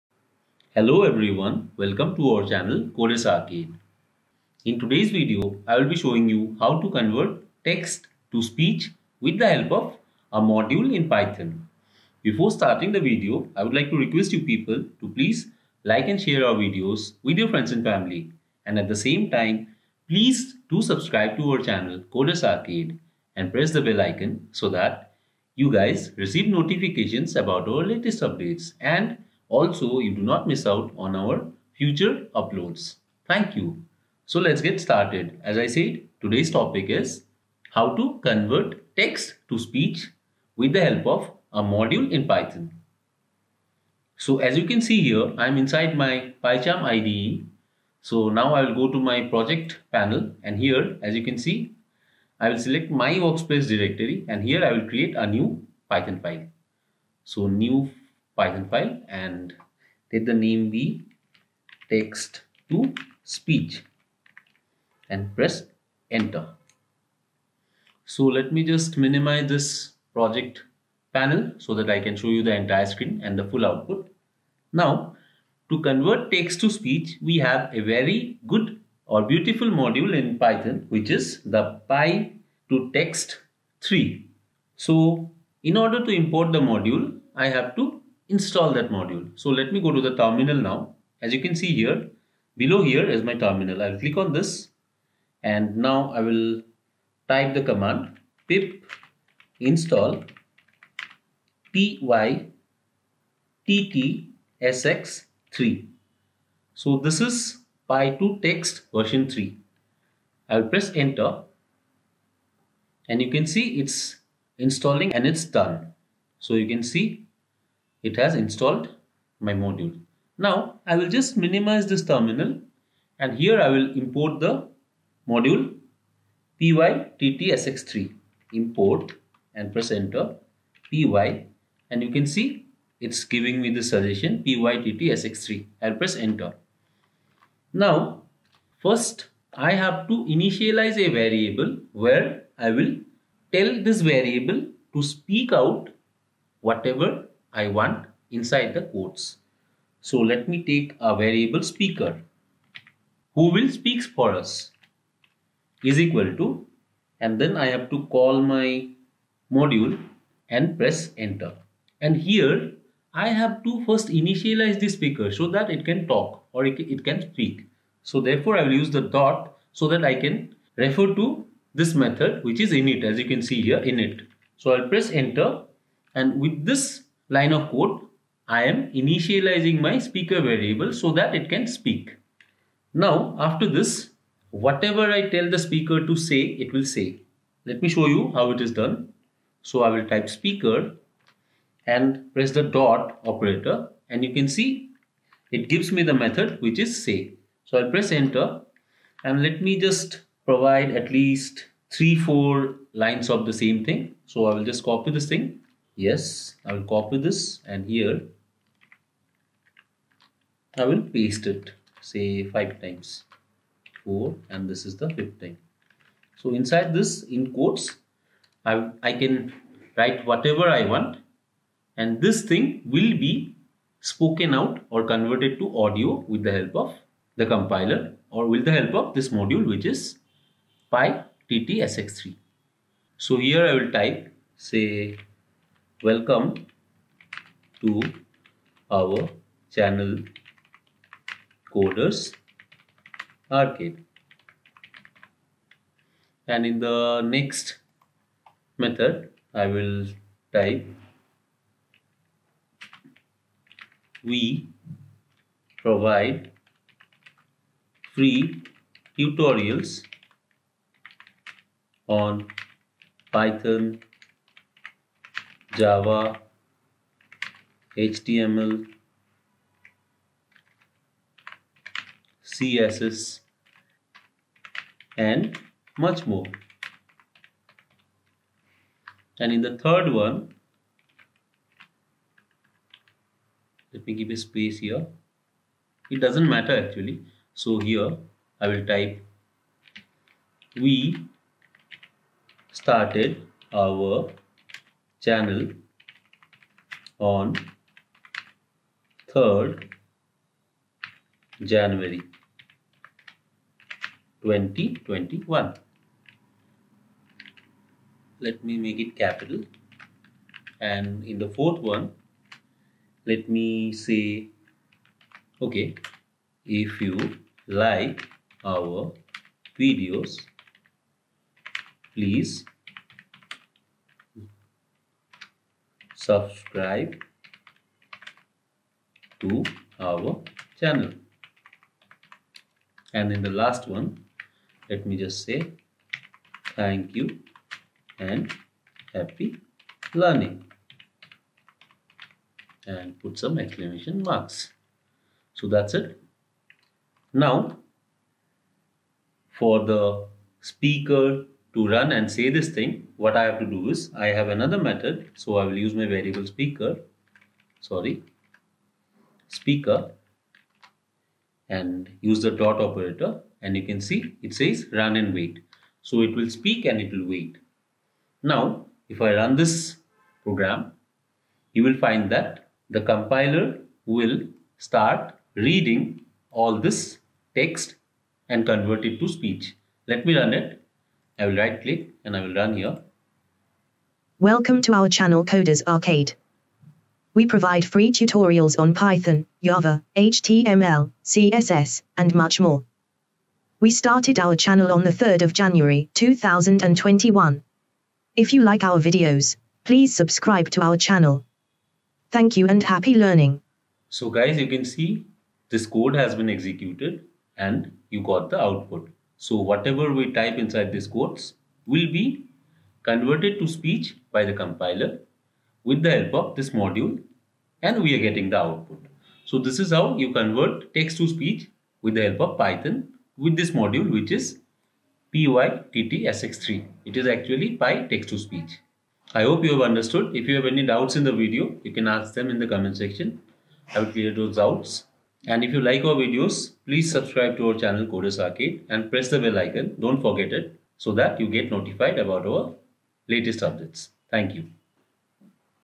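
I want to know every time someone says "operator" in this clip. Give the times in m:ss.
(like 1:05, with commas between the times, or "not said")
3:13, 6:02.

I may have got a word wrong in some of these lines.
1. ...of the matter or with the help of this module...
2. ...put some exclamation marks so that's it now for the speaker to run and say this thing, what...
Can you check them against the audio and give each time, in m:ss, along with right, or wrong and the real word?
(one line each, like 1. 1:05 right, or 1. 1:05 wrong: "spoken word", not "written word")
1. 3:46 wrong: "compiler", not "matter"
2. 5:43 right.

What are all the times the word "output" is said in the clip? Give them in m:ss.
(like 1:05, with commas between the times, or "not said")
1:13, 6:48, 6:58.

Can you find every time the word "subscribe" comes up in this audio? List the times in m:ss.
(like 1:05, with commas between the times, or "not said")
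0:20, 5:26, 6:40, 7:17.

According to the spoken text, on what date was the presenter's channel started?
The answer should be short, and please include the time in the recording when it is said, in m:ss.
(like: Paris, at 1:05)
3rd January 2021, at 4:59.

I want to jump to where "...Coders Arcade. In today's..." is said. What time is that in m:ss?
0:02.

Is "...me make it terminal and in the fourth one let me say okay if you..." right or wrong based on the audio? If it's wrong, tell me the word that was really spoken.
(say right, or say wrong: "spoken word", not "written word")
wrong: "capital", not "terminal".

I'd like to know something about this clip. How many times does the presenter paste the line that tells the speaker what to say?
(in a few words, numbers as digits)
5.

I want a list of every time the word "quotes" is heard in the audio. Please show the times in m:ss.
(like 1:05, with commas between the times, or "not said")
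2:28, 3:37, 6:51.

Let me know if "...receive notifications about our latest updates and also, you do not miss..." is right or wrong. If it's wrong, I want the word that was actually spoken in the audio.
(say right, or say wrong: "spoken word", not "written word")
right.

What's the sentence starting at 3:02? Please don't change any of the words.
Now, after this, whatever I tell the speaker to say, it will say.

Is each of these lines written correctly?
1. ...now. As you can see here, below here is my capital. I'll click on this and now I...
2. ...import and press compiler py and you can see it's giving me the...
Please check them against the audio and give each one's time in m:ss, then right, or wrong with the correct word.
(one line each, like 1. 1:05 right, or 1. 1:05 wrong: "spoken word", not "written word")
1. 1:30 wrong: "terminal", not "capital"
2. 2:08 wrong: "enter", not "compiler".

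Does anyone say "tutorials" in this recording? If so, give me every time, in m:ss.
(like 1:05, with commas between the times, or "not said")
4:19, 6:28.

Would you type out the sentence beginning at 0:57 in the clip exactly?
So new Python file and let the name be text to speech and press enter.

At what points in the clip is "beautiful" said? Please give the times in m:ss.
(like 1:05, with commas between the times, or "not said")
1:19.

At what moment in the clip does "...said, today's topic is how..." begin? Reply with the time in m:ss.
0:35.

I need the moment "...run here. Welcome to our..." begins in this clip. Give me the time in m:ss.
6:22.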